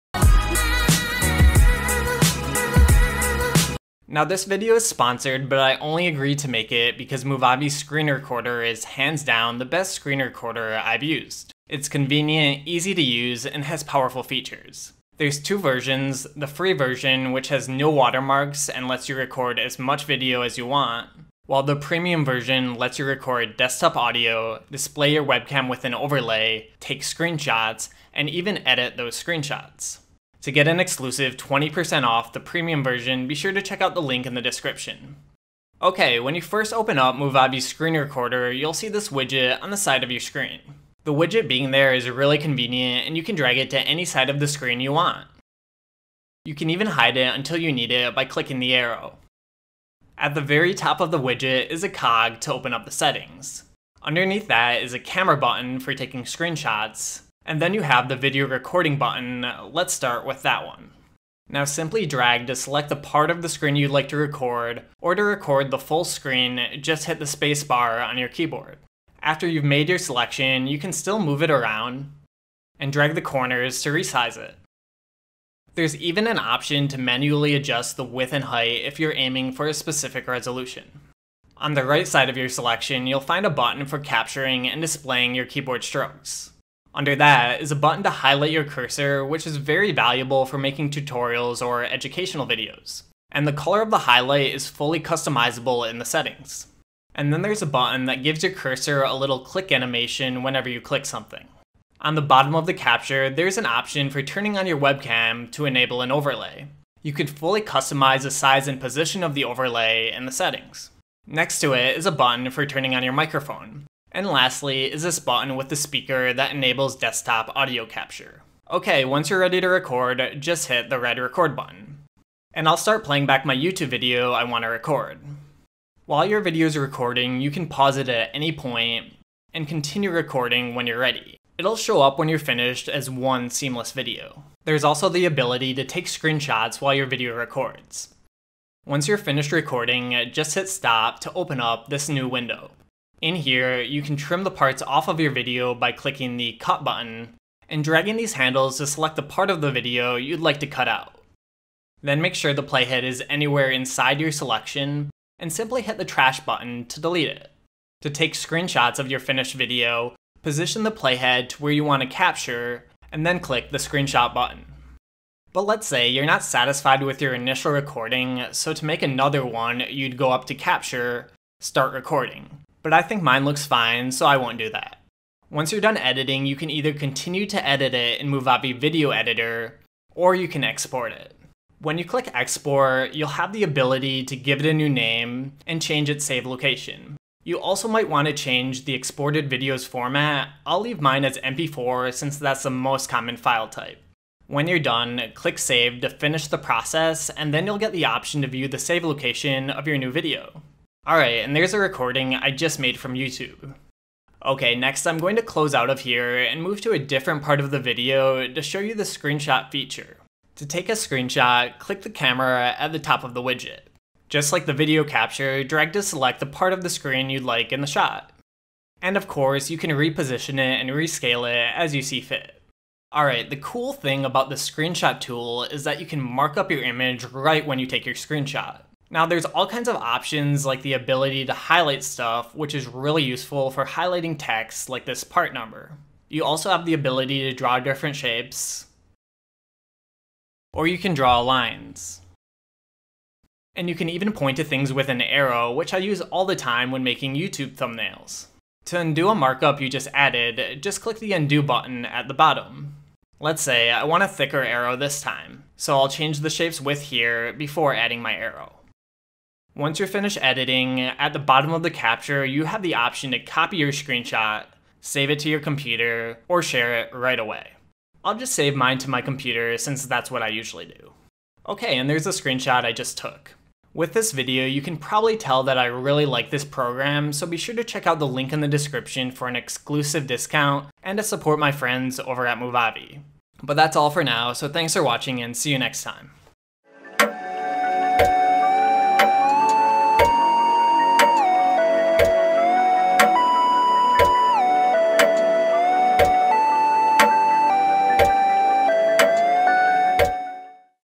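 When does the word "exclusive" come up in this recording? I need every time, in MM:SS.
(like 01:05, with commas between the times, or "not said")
00:30, 04:39.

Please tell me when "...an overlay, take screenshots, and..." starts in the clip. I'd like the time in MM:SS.
00:25.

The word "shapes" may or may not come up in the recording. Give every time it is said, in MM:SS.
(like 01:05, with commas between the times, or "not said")
03:58, 04:16.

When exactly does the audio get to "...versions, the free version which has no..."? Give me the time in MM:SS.
00:15.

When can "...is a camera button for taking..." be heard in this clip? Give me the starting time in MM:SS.
00:54.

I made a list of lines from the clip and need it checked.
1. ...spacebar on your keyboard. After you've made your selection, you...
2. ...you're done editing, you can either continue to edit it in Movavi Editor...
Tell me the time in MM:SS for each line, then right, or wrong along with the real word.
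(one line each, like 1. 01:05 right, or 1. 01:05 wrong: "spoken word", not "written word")
1. 01:07 right
2. 02:55 wrong: "Video", not "Editor".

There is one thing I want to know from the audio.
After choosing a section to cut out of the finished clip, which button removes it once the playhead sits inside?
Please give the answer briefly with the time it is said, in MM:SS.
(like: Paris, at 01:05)
trash, at 02:36.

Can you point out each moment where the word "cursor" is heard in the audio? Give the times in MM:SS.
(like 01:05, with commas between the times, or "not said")
01:28, 01:38.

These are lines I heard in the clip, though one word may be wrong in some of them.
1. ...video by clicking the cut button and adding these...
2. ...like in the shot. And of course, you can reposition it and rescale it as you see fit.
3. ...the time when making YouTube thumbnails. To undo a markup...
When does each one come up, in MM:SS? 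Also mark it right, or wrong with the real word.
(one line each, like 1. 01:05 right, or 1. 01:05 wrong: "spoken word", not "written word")
1. 02:25 wrong: "dragging", not "adding"
2. 03:37 right
3. 04:06 right.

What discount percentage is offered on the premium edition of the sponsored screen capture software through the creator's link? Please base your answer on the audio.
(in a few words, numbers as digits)
20%.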